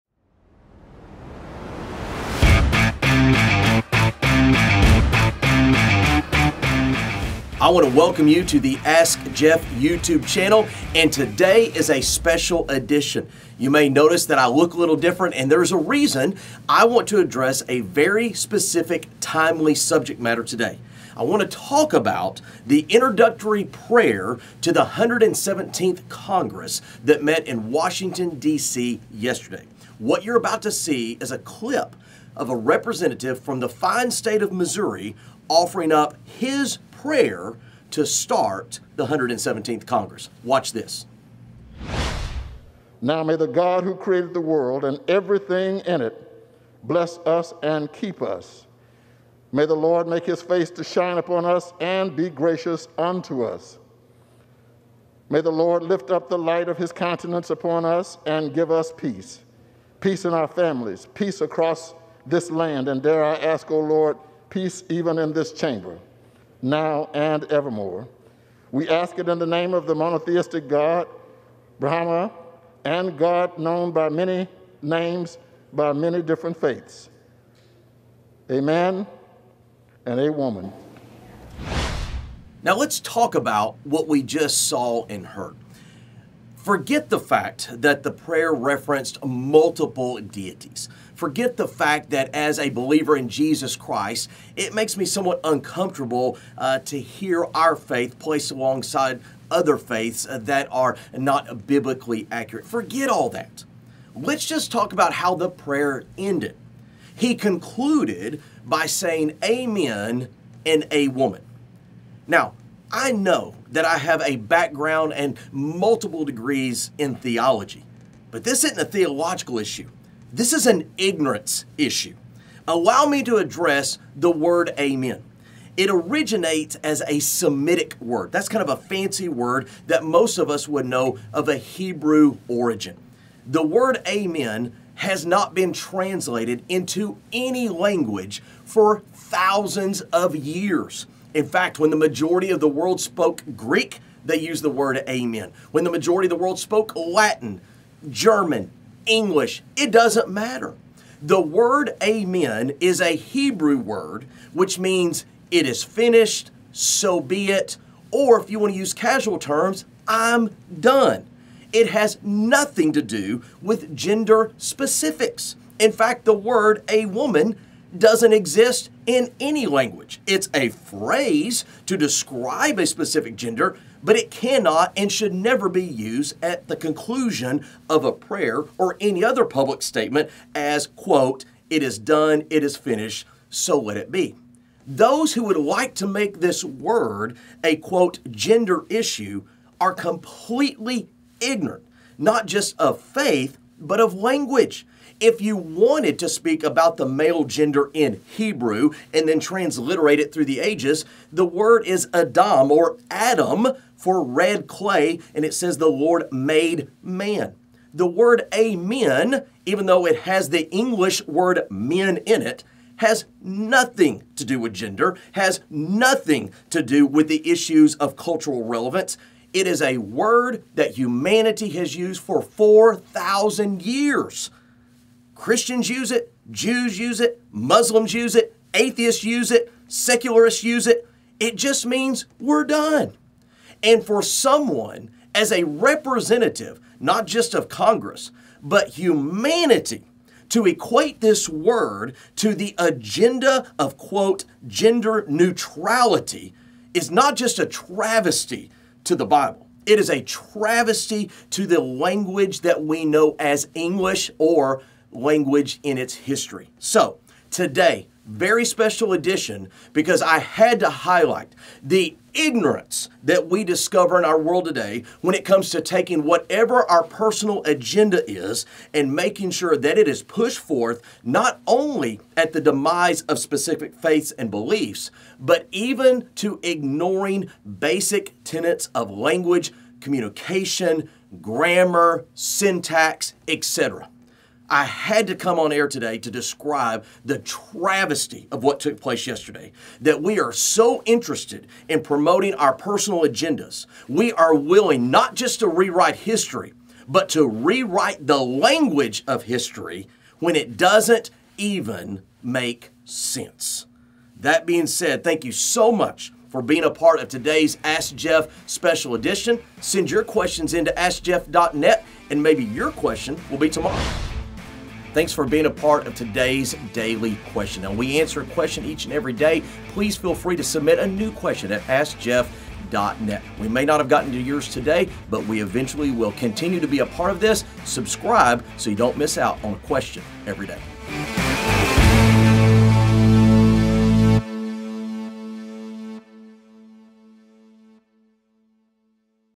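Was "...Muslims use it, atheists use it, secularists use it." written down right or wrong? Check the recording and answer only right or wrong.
right.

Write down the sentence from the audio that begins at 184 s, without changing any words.
Those who would like to make this word a, quote, gender issue are completely ignorant, not just of faith, but of language.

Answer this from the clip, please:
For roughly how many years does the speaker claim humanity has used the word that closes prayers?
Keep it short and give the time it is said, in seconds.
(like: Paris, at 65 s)
4,000, at 222 s.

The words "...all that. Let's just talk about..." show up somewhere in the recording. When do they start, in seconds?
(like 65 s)
103 s.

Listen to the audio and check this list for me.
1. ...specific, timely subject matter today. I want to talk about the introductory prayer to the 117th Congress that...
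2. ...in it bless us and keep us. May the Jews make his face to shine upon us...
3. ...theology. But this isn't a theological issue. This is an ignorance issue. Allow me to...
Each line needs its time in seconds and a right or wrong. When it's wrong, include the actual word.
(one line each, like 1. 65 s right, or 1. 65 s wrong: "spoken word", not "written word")
1. 18 s right
2. 45 s wrong: "Lord", not "Jews"
3. 117 s right.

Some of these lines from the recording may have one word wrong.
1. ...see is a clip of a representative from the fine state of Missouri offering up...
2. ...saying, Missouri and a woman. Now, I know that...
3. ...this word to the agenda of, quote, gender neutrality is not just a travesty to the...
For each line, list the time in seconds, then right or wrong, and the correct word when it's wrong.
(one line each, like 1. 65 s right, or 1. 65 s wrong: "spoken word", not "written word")
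1. 30 s right
2. 108 s wrong: "Amen", not "Missouri"
3. 241 s right.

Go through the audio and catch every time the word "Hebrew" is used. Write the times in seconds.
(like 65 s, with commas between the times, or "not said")
131 s, 153 s, 198 s.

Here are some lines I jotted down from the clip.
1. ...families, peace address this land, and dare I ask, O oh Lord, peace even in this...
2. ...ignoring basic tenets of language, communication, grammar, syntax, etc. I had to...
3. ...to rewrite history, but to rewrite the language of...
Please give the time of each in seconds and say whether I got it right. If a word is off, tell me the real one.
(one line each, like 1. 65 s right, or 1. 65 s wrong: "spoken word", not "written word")
1. 60 s wrong: "across", not "address"
2. 276 s right
3. 295 s right.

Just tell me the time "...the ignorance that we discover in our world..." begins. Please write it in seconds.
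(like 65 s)
261 s.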